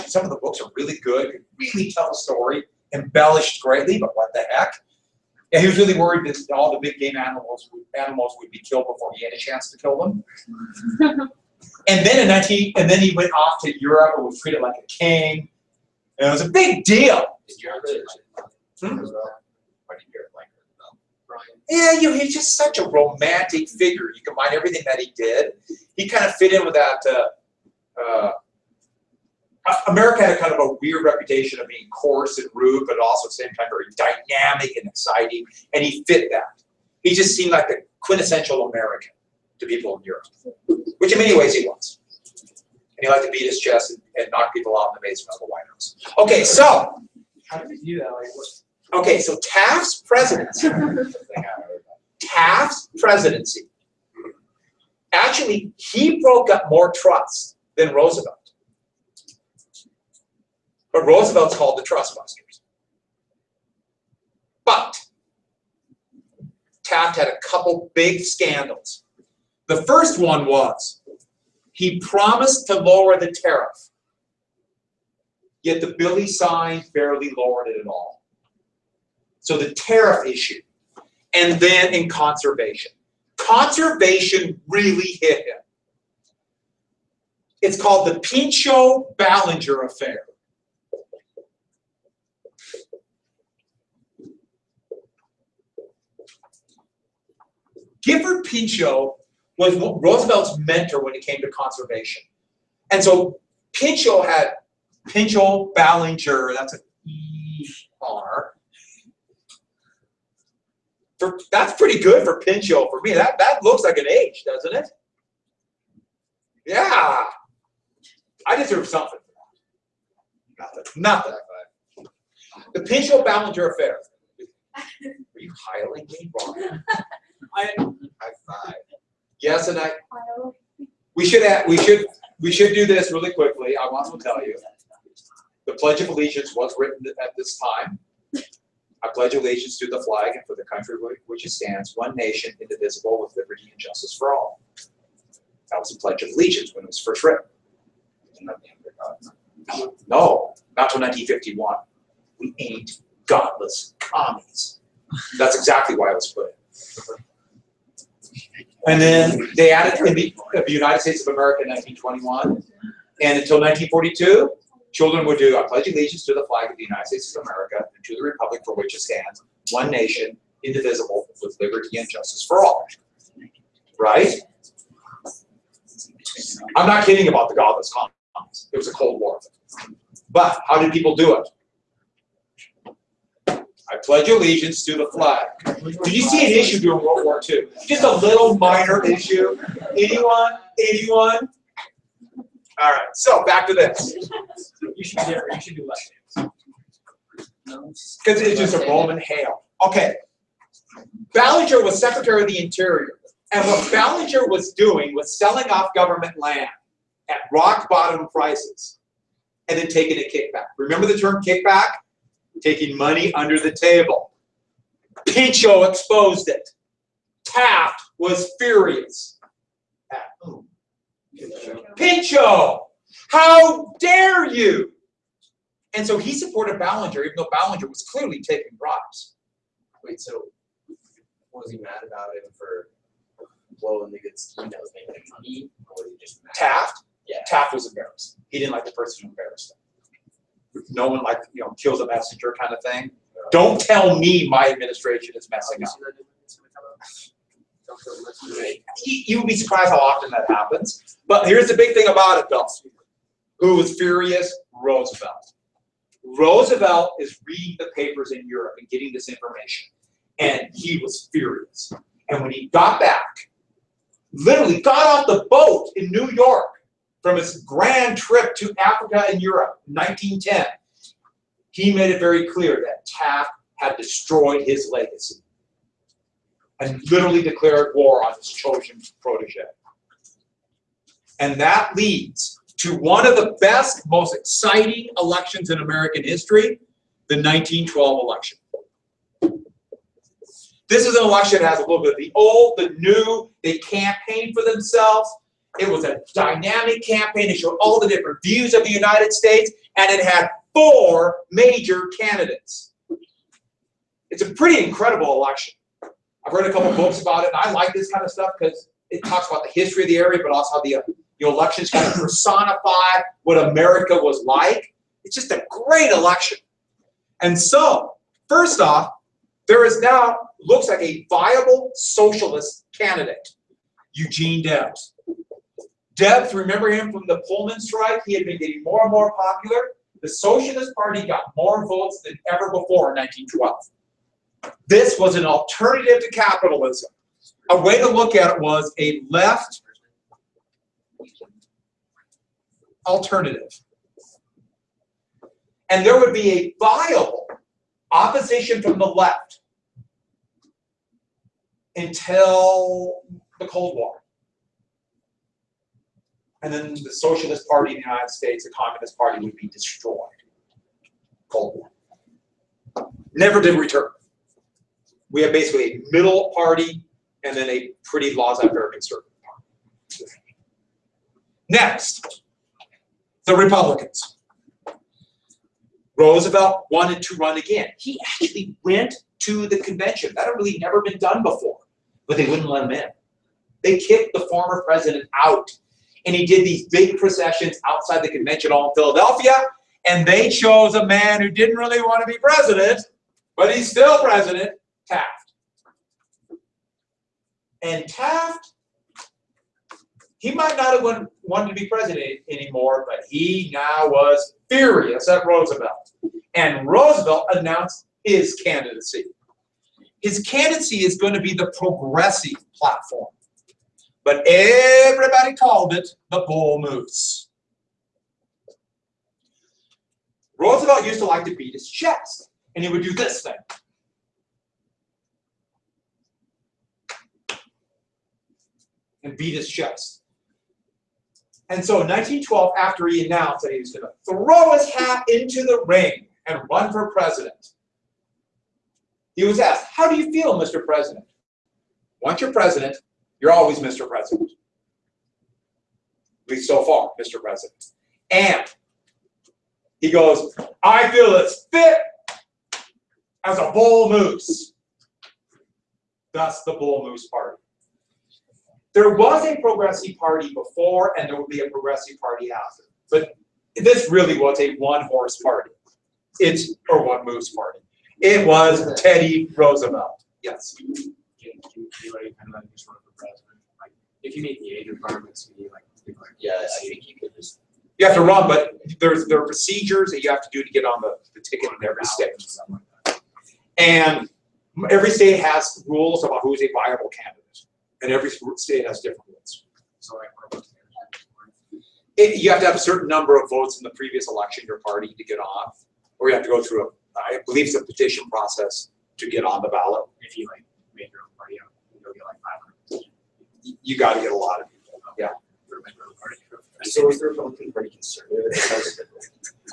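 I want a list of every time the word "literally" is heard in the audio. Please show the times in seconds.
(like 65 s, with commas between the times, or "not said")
264 s, 277 s.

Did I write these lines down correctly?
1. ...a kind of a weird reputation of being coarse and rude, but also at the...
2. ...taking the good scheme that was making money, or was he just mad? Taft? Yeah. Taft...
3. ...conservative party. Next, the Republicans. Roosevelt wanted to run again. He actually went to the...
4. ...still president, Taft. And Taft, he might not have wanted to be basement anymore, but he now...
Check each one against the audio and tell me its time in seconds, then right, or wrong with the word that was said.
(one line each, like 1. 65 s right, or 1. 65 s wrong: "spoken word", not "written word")
1. 30 s right
2. 233 s wrong: "blowing", not "taking"
3. 368 s right
4. 393 s wrong: "president", not "basement".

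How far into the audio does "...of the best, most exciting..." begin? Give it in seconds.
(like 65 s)
283 s.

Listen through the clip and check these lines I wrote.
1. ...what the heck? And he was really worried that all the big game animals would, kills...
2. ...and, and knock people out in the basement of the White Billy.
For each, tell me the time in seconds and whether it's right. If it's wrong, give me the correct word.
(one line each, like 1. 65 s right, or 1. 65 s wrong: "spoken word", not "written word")
1. 4 s wrong: "animals", not "kills"
2. 43 s wrong: "House", not "Billy".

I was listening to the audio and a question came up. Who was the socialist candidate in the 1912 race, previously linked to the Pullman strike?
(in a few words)
Eugene Debs.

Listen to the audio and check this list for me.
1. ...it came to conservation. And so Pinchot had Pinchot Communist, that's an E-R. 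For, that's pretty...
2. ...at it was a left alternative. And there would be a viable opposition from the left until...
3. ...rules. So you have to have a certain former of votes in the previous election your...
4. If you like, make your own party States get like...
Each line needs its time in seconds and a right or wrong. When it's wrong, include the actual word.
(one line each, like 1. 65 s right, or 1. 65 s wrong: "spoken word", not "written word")
1. 101 s wrong: "Ballinger", not "Communist"
2. 338 s right
3. 489 s wrong: "number", not "former"
4. 500 s wrong: "You", not "States".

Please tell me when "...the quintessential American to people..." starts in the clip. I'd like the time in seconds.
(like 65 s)
37 s.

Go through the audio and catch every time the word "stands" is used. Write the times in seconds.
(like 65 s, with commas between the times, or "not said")
141 s, 169 s.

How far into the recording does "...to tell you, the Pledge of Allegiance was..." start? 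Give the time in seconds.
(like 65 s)
134 s.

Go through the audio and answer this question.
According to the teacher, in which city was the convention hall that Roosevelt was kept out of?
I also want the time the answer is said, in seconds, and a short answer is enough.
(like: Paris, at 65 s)
Philadelphia, at 389 s.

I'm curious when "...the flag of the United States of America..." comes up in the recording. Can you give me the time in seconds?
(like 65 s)
166 s.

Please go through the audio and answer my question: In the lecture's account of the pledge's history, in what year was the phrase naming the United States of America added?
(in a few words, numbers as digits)
1921.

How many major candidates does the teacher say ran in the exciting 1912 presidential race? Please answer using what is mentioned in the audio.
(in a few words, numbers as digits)
4.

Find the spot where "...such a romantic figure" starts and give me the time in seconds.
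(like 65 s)
22 s.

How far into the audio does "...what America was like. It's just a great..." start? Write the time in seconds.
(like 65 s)
313 s.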